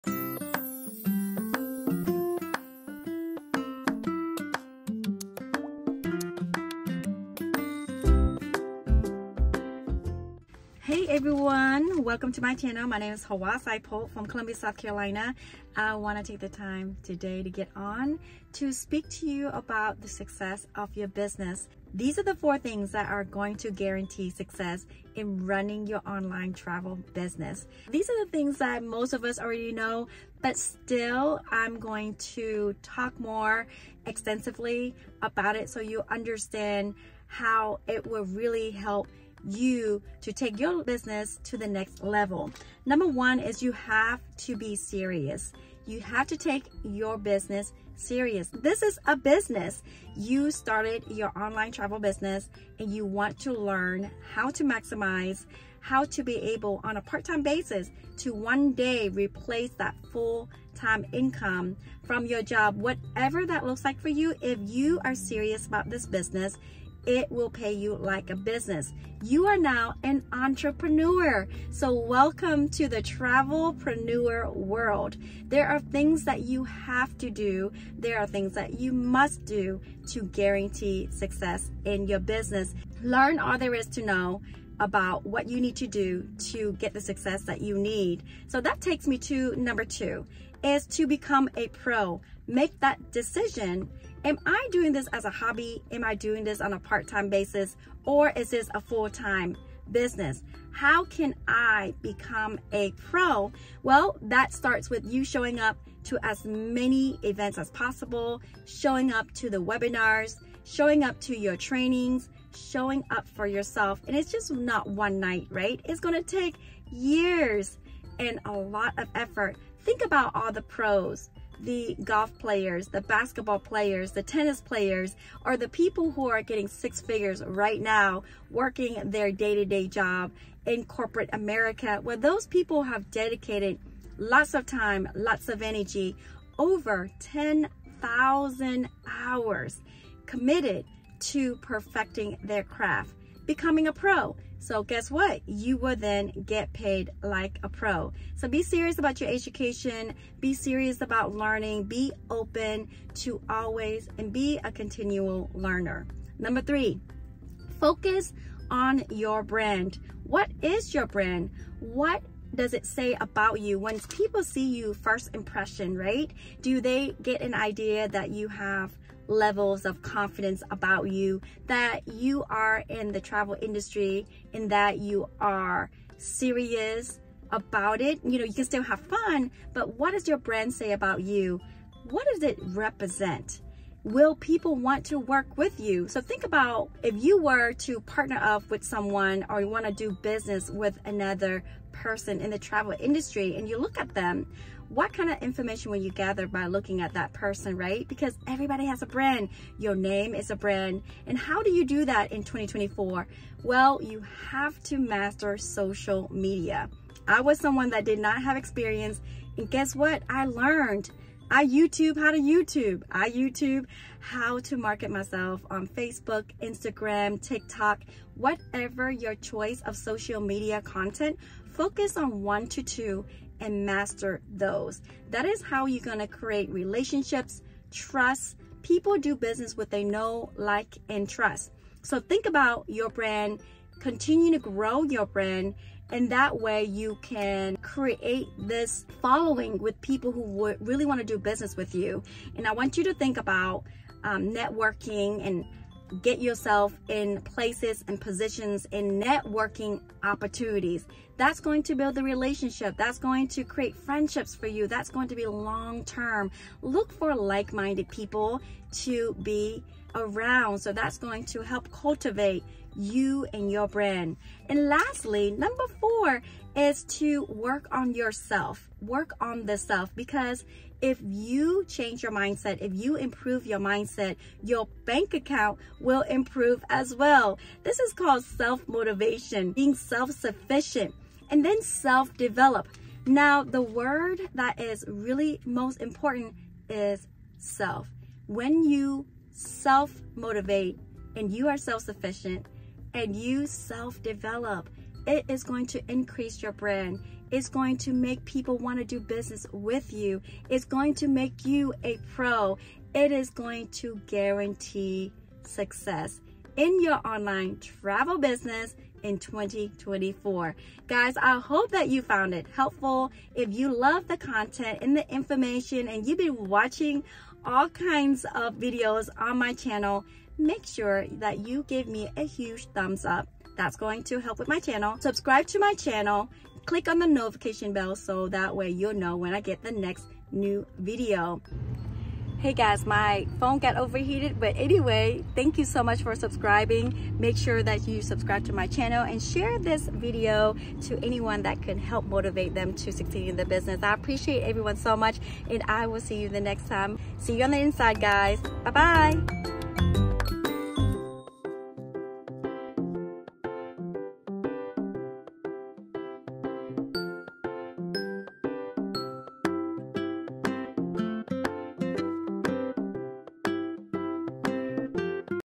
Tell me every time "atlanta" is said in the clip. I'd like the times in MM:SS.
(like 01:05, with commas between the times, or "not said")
not said.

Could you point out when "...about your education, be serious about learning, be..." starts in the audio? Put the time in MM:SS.
02:28.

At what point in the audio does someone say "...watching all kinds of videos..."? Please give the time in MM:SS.
05:16.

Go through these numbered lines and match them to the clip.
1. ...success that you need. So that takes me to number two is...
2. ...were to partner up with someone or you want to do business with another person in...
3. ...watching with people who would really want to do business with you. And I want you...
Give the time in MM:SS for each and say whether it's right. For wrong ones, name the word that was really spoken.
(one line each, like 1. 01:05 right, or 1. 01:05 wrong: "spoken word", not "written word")
1. 01:27 right
2. 03:07 right
3. 03:59 wrong: "following", not "watching".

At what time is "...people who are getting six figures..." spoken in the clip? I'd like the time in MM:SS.
02:05.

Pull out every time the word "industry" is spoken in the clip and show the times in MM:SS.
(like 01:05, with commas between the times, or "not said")
02:53, 03:12.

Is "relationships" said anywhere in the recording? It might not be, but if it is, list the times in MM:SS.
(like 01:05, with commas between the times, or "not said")
03:46, 04:12.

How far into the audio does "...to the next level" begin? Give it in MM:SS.
00:41.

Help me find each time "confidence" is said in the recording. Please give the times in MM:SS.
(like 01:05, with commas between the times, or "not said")
02:50.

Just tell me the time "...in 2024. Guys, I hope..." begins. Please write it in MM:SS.
05:09.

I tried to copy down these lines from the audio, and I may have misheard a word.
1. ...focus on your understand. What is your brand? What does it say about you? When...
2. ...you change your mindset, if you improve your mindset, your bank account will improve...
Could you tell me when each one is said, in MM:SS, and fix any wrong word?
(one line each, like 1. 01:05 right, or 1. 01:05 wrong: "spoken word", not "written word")
1. 02:37 wrong: "brand", not "understand"
2. 04:31 right.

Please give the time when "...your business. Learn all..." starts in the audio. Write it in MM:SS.
01:22.